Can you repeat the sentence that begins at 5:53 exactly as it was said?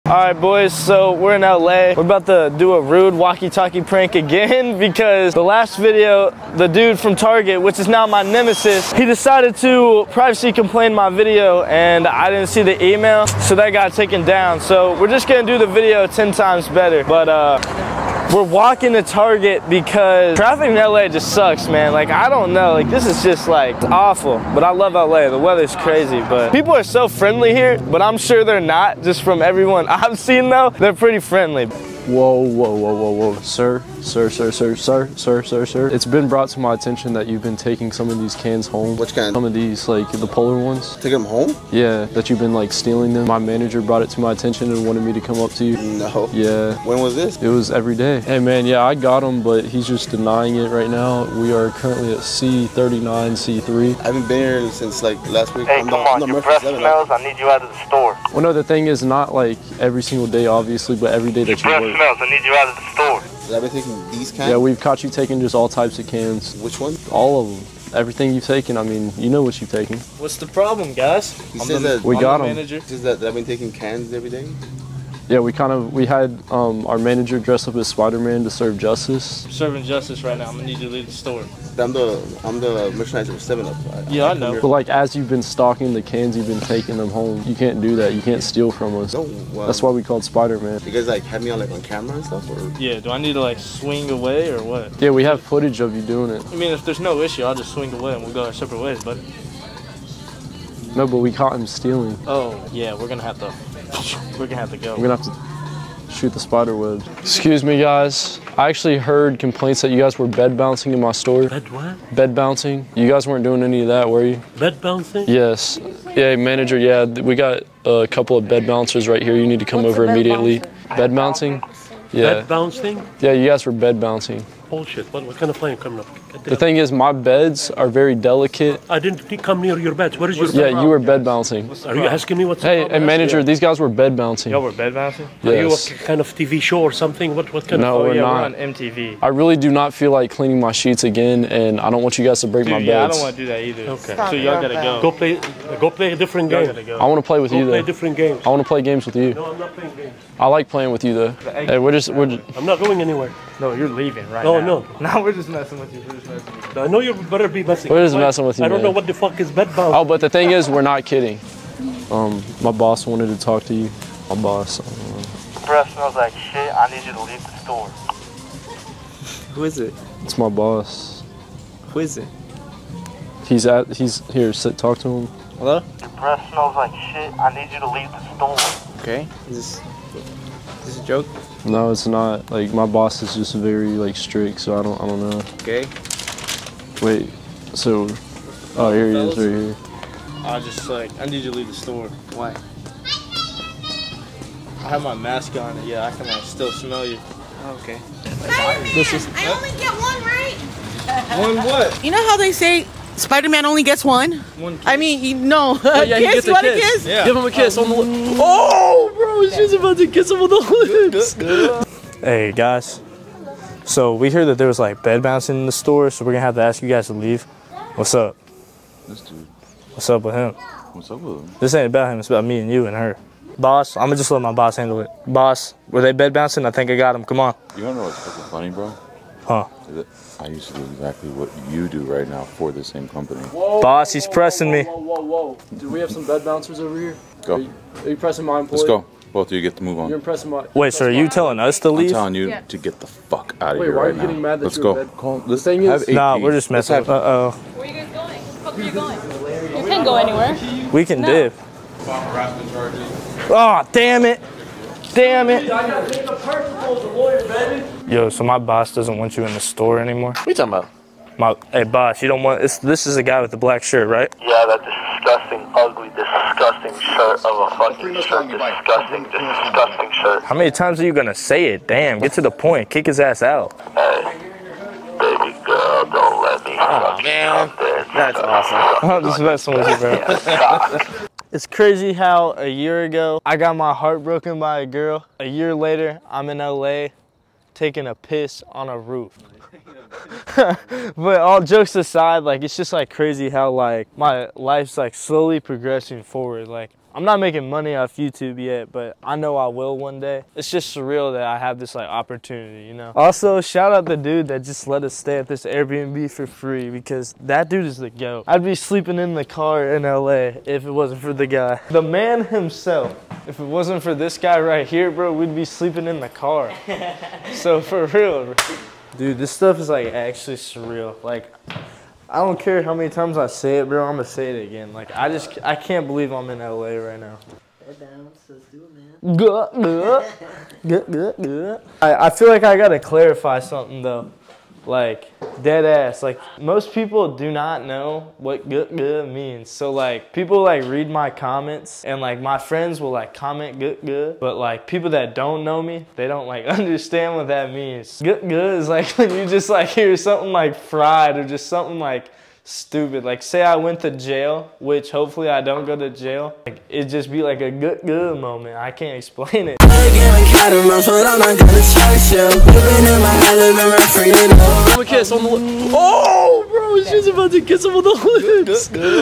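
Like say I went to jail, which hopefully I don't go to jail.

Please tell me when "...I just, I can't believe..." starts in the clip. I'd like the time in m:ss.
5:25.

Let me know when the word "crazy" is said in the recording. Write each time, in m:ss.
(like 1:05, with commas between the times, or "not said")
0:25, 4:41, 4:53.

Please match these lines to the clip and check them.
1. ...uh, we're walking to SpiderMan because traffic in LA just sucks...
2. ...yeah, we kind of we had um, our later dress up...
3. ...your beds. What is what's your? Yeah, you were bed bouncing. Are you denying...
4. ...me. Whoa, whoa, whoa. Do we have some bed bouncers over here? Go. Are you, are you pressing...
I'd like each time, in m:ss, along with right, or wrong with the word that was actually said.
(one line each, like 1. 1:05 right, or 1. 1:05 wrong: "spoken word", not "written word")
1. 0:17 wrong: "Target", not "SpiderMan"
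2. 1:15 wrong: "manager", not "later"
3. 2:09 wrong: "asking", not "denying"
4. 3:54 right.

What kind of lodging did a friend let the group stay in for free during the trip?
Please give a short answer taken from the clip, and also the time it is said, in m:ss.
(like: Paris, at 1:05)
Airbnb, at 5:05.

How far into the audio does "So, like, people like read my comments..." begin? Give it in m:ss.
5:39.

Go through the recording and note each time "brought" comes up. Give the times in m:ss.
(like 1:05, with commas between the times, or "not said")
0:36, 0:43.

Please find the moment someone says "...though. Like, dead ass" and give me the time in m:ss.
5:34.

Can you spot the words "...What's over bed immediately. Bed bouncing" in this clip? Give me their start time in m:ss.
1:59.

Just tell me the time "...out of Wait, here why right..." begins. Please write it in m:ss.
4:03.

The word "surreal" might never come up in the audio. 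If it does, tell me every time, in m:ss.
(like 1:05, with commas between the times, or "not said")
5:00, 5:20.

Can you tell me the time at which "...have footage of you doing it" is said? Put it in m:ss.
1:35.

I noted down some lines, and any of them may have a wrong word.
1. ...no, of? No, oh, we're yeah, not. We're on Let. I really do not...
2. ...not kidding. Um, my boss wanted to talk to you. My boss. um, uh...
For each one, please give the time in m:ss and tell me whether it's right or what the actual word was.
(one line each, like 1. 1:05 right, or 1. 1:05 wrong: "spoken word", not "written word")
1. 2:17 wrong: "MTV", not "Let"
2. 2:40 right.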